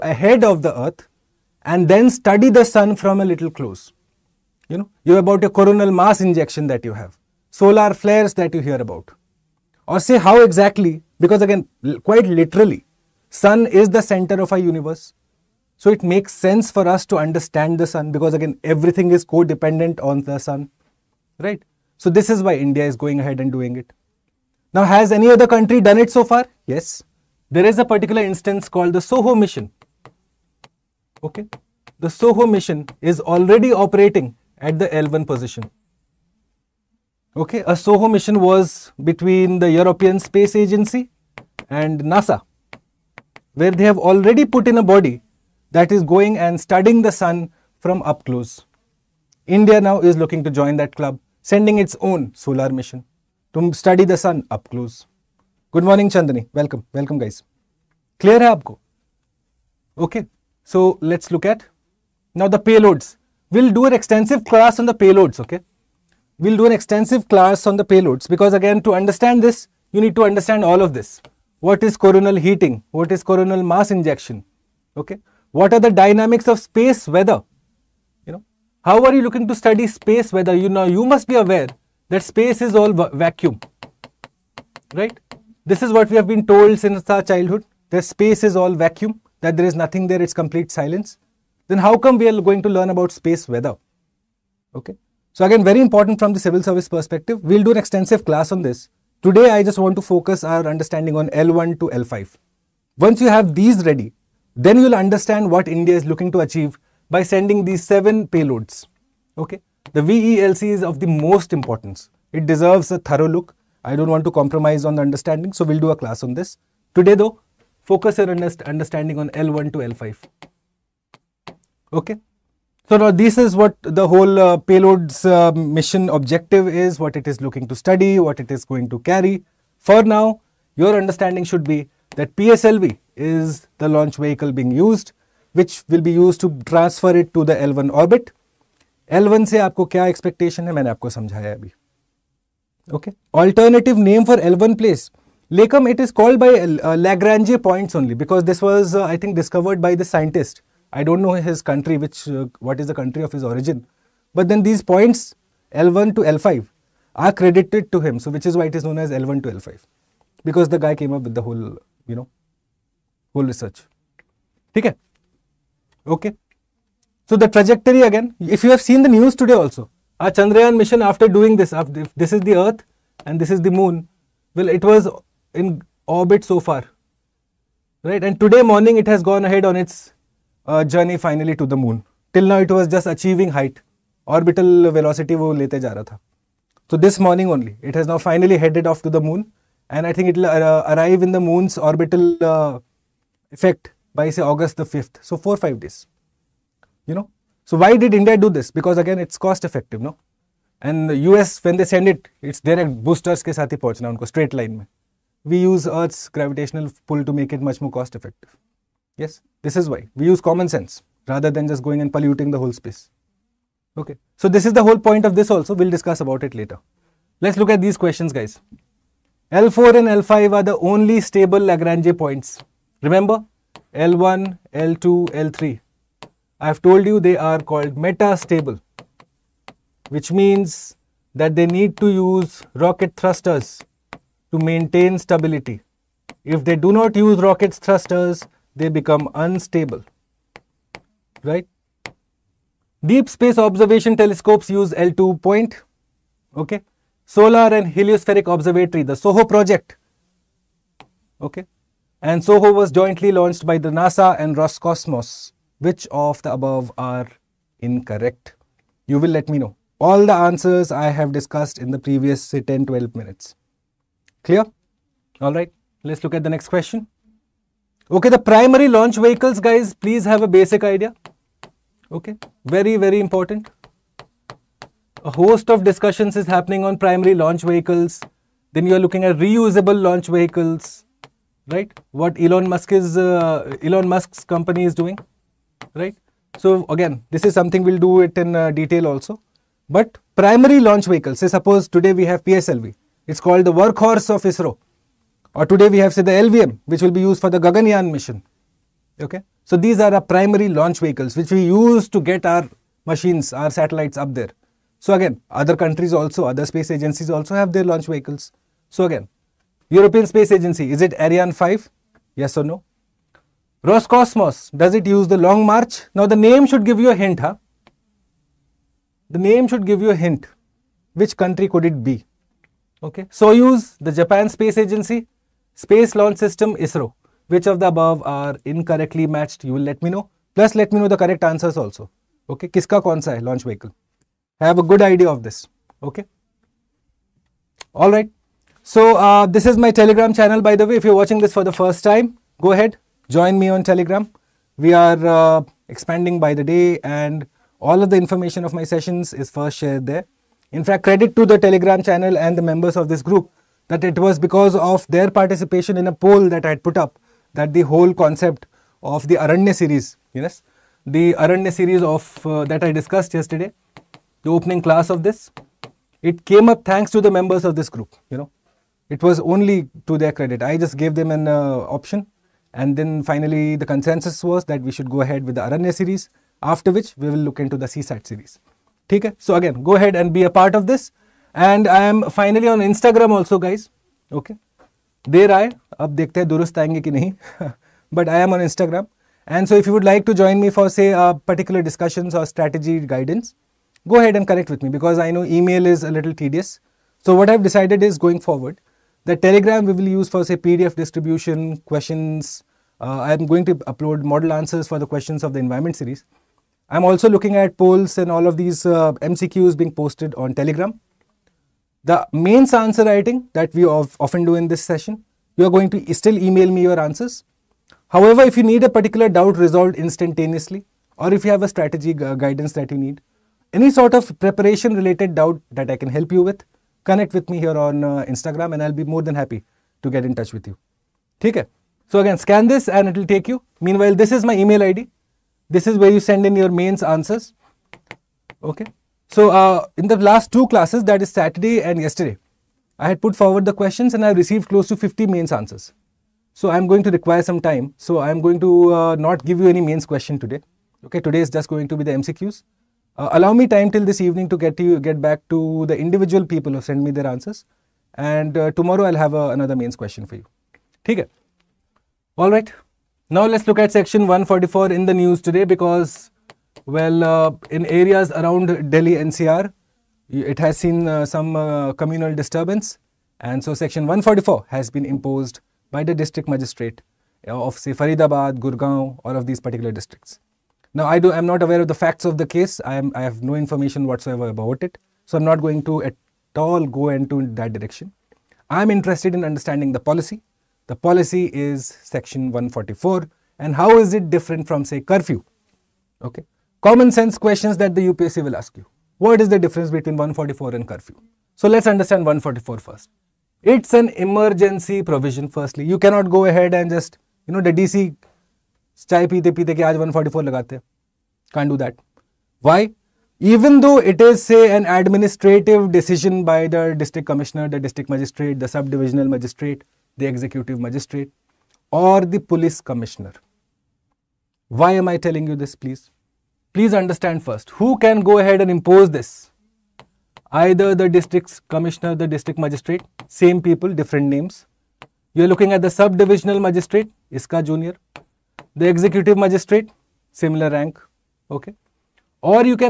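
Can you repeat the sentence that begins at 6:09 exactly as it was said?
It was only to their credit.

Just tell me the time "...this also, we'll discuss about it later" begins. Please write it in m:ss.
3:35.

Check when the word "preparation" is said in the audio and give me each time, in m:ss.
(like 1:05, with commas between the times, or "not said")
7:04.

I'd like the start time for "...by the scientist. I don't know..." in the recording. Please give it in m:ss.
2:29.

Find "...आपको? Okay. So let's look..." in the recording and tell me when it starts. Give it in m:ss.
0:58.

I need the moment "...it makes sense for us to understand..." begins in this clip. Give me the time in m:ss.
0:15.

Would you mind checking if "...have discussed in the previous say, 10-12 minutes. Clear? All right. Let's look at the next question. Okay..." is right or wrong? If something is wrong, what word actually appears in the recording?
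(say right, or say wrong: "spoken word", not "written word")
right.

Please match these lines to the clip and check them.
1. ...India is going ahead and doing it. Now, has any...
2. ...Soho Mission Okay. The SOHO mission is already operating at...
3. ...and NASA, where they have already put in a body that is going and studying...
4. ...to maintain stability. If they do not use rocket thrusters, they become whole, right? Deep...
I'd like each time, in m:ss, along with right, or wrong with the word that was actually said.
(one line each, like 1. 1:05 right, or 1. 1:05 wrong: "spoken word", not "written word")
1. 0:22 right
2. 0:29 right
3. 0:41 right
4. 3:54 wrong: "unstable", not "whole".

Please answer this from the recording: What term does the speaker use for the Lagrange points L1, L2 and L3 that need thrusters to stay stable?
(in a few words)
metastable.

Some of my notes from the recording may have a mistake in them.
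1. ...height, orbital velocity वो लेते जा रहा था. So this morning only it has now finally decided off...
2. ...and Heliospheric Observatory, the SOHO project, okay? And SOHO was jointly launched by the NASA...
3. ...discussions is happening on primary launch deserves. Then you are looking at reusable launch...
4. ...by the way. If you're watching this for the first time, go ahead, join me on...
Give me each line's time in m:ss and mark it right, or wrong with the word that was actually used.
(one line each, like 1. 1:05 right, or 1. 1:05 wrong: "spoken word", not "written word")
1. 3:03 wrong: "headed", not "decided"
2. 4:07 right
3. 4:35 wrong: "vehicles", not "deserves"
4. 5:40 right.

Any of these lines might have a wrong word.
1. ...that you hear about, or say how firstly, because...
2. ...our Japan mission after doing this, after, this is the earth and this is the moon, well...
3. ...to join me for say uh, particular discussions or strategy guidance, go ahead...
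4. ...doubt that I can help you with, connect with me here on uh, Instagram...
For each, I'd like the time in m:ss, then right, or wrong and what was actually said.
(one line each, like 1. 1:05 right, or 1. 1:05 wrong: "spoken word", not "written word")
1. 0:08 wrong: "exactly", not "firstly"
2. 2:50 wrong: "Chandrayaan", not "Japan"
3. 6:30 right
4. 7:05 right.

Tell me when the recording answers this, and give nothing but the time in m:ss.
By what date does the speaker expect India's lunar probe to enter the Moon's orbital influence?
3:14.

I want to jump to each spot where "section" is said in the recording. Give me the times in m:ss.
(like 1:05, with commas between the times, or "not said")
7:43, 7:53, 8:12.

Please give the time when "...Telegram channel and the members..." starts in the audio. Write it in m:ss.
5:51.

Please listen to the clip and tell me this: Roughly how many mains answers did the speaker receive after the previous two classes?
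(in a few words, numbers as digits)
50.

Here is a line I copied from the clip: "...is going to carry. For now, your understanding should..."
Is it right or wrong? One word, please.
right.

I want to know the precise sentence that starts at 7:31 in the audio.
Okay, today is just going to be the MCQs.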